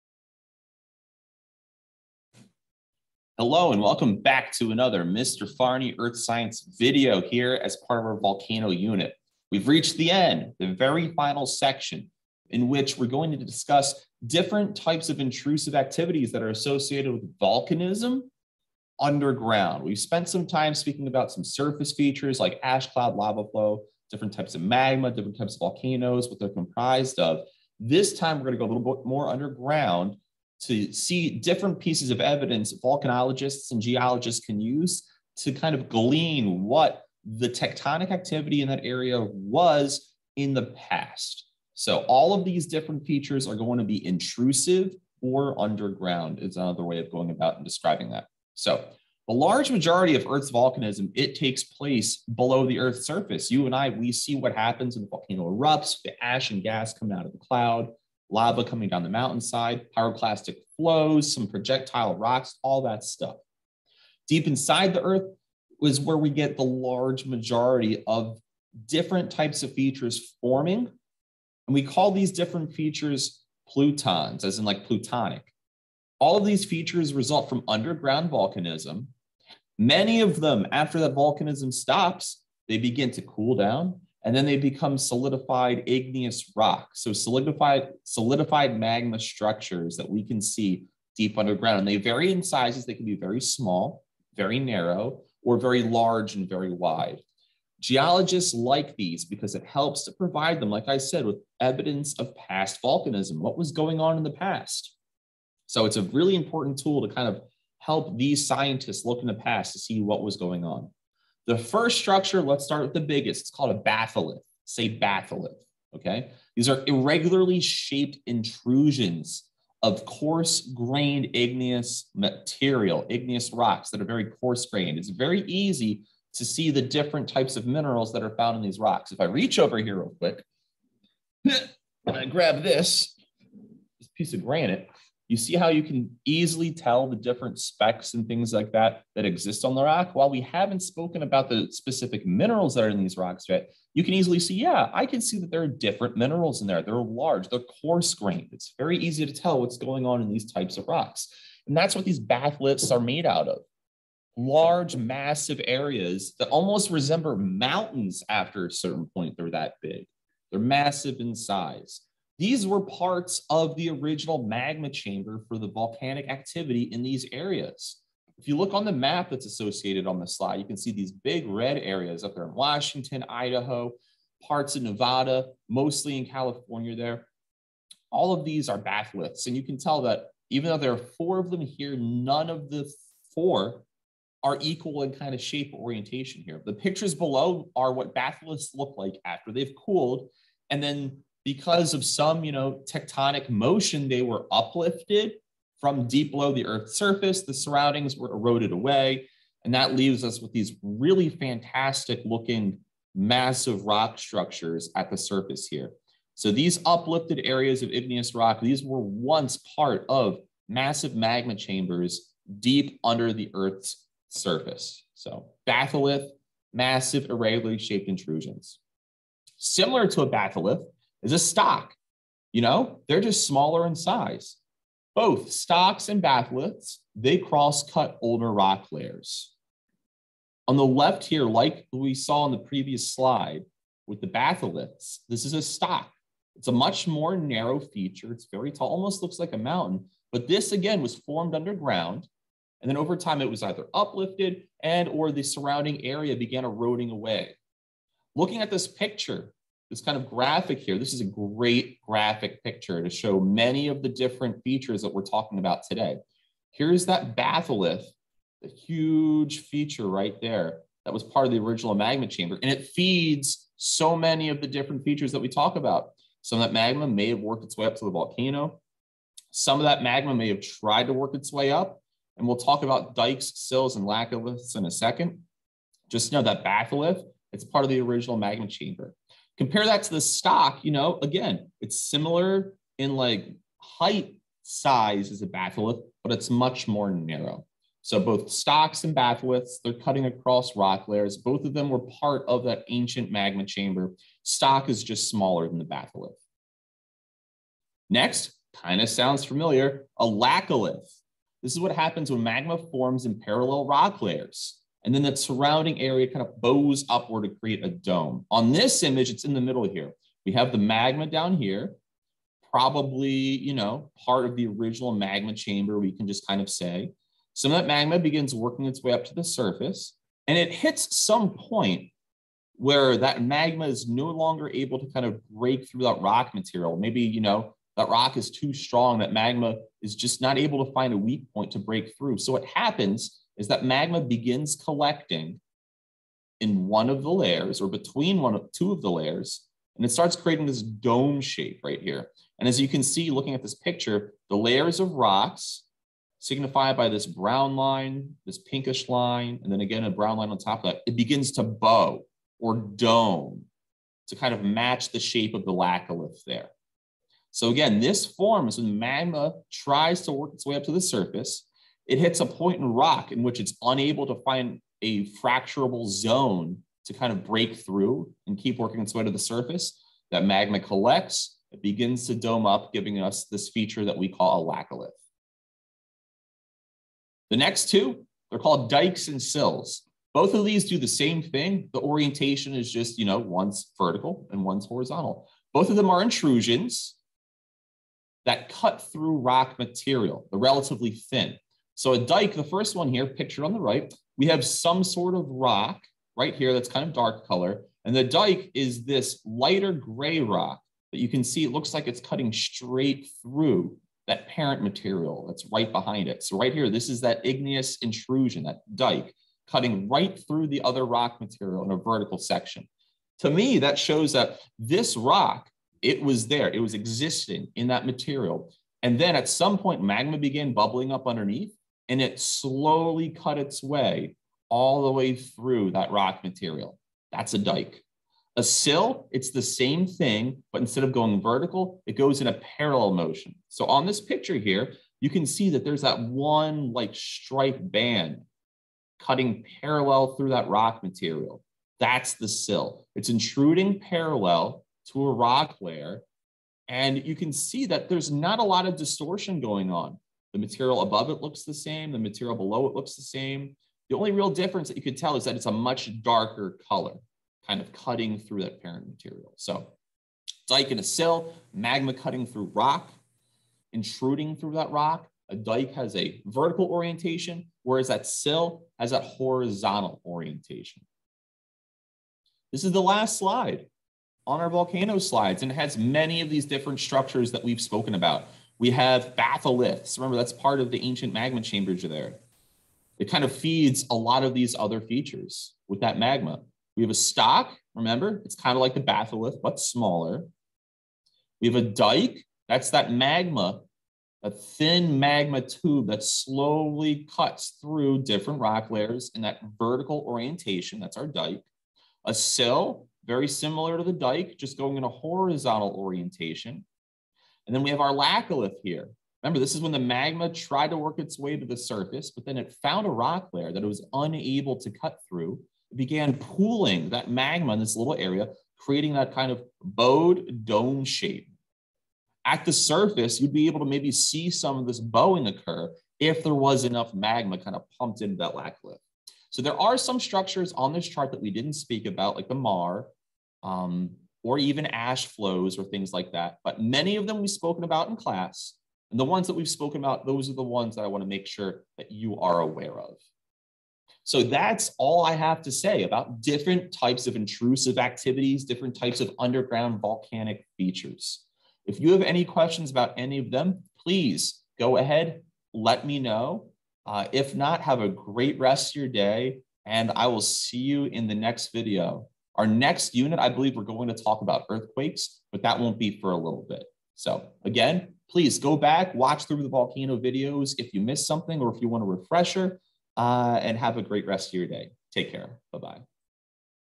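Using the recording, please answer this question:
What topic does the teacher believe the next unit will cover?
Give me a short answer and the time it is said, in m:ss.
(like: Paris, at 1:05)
earthquakes, at 9:24.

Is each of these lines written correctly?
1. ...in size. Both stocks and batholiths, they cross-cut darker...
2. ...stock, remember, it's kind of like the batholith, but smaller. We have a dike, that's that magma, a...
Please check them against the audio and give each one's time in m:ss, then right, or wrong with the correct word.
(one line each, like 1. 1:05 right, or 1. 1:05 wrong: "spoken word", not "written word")
1. 3:43 wrong: "older", not "darker"
2. 8:07 right.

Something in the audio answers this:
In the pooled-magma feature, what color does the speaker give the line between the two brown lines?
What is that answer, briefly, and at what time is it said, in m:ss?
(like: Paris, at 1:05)
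pinkish, at 5:48.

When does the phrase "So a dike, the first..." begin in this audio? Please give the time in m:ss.
6:32.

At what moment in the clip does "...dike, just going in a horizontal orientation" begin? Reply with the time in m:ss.
8:24.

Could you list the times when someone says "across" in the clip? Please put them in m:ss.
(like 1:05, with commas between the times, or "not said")
4:50.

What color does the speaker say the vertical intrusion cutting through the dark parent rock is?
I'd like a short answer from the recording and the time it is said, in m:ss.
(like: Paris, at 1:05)
lighter gray, at 6:39.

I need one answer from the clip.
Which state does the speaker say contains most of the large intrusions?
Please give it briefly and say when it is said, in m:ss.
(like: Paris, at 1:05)
California, at 2:55.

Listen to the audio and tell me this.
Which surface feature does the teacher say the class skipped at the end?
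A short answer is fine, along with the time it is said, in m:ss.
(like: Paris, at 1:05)
maar, at 8:52.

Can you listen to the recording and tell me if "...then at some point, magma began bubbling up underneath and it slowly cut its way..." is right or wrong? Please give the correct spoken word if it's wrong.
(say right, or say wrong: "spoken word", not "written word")
right.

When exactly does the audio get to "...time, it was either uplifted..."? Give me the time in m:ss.
4:03.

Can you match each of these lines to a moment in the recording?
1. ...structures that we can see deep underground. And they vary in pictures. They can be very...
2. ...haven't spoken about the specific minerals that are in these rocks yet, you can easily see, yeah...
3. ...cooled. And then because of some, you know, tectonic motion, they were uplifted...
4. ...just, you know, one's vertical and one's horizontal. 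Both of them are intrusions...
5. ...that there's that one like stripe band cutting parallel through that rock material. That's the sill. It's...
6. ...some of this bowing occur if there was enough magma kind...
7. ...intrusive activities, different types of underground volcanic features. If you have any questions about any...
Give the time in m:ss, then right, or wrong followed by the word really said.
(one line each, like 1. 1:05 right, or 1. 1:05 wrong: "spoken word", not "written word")
1. 1:29 wrong: "sizes", not "pictures"
2. 2:20 right
3. 3:09 right
4. 6:22 right
5. 7:15 right
6. 8:44 right
7. 9:07 right.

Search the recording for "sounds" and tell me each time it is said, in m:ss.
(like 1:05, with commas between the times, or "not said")
4:59.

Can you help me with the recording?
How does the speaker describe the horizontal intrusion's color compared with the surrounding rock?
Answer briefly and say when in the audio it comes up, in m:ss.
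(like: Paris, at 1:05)
much darker, at 7:35.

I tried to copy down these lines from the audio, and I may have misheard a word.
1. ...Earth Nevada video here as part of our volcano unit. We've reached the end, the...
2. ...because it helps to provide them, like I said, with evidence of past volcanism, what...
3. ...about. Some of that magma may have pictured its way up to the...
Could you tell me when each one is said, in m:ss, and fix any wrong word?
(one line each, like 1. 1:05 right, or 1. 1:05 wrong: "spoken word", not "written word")
1. 0:05 wrong: "Science", not "Nevada"
2. 1:39 right
3. 4:25 wrong: "worked", not "pictured".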